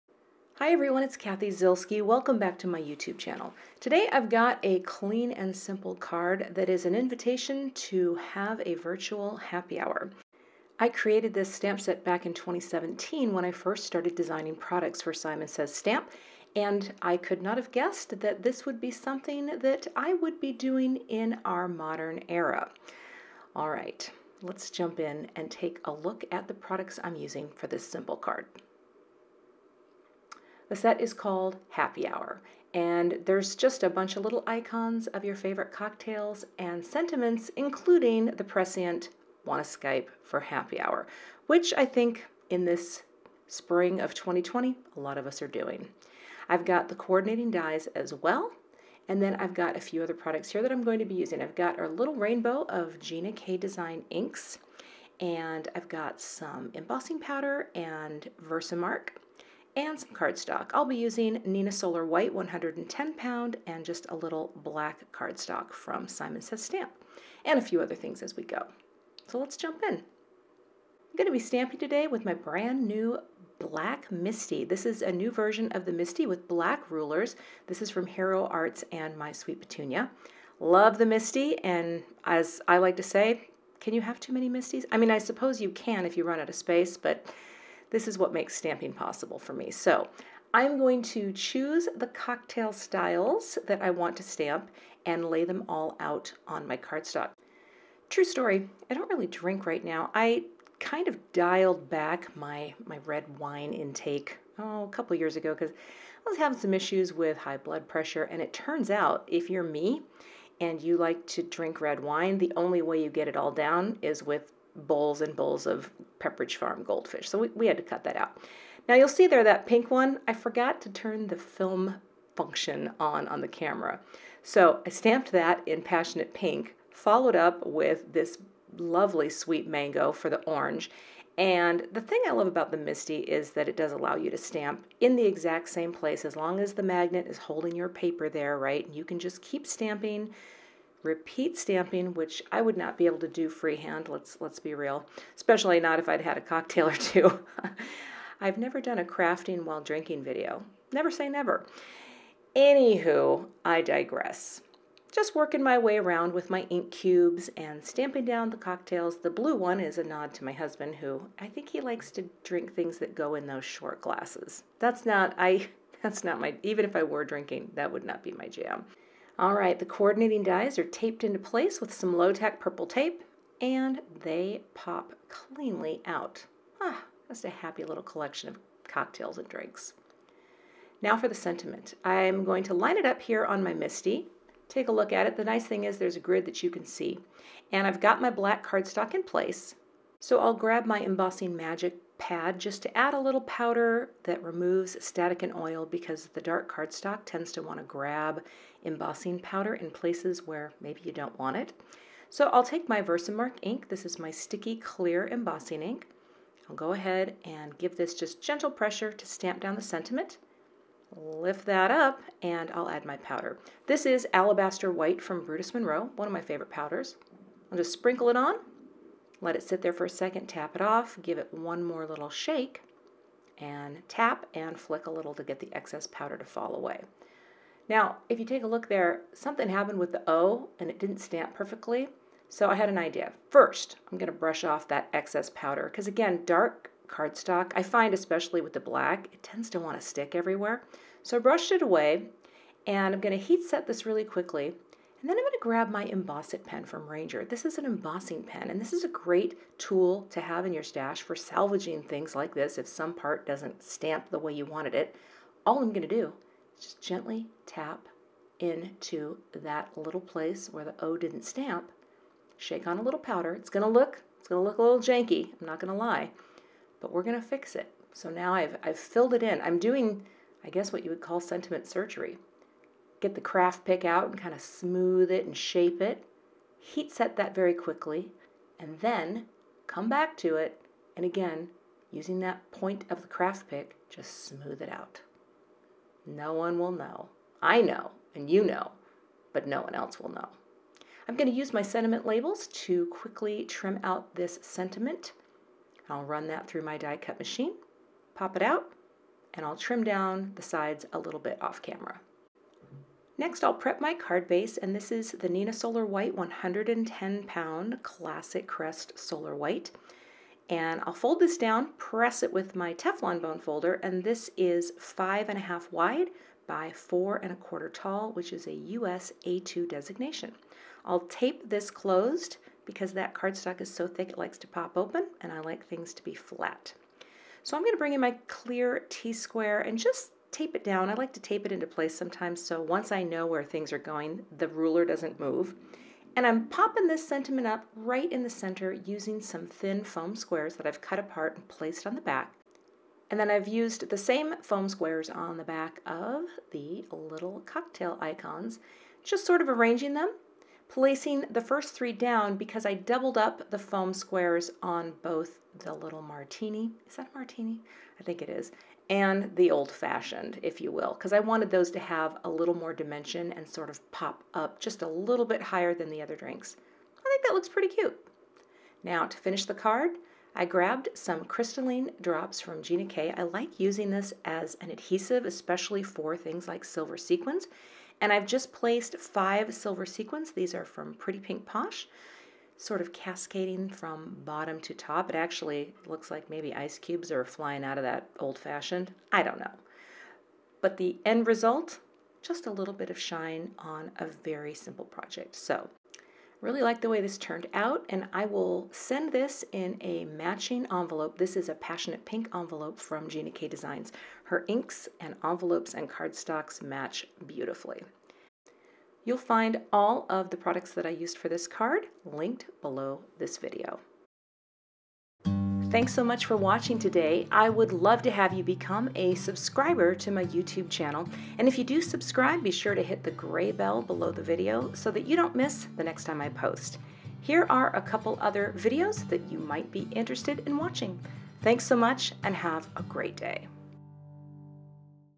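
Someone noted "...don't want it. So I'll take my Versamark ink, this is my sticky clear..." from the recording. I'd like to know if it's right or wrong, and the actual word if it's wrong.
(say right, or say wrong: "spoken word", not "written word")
right.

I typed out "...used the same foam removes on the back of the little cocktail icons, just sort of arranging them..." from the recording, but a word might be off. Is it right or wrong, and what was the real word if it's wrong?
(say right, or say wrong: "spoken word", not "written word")
wrong: "squares", not "removes".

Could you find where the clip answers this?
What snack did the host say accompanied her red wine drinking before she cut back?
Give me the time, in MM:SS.
01:56.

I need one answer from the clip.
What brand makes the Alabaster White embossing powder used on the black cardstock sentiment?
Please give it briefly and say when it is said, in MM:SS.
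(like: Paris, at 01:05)
Brutus Monroe, at 03:35.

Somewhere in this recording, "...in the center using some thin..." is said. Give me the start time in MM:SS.
05:38.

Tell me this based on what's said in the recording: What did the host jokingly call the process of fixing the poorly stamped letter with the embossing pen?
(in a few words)
Sentiment surgery.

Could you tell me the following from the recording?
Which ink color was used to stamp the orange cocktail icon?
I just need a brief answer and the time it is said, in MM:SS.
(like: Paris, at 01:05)
Sweet Mango, at 02:09.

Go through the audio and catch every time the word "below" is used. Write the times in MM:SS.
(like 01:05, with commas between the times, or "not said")
06:52, 07:04.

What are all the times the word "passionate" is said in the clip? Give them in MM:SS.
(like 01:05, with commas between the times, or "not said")
02:05, 06:41.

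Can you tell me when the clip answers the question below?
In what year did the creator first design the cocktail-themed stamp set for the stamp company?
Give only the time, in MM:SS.
00:12.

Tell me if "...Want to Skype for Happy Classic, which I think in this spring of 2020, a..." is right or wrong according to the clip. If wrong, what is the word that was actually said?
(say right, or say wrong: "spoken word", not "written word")
wrong: "Hour", not "Classic".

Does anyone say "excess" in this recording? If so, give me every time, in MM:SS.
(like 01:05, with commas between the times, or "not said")
03:45, 03:55.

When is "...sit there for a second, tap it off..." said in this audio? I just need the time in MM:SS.
03:39.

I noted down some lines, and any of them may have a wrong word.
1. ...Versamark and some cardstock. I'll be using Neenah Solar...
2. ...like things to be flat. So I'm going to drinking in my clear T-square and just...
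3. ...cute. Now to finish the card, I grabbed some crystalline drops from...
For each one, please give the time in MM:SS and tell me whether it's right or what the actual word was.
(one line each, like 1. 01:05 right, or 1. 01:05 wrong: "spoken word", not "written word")
1. 00:58 right
2. 05:25 wrong: "bring", not "drinking"
3. 06:07 right.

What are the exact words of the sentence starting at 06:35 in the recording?
So really like the way this turned out and I will send this in a matching envelope.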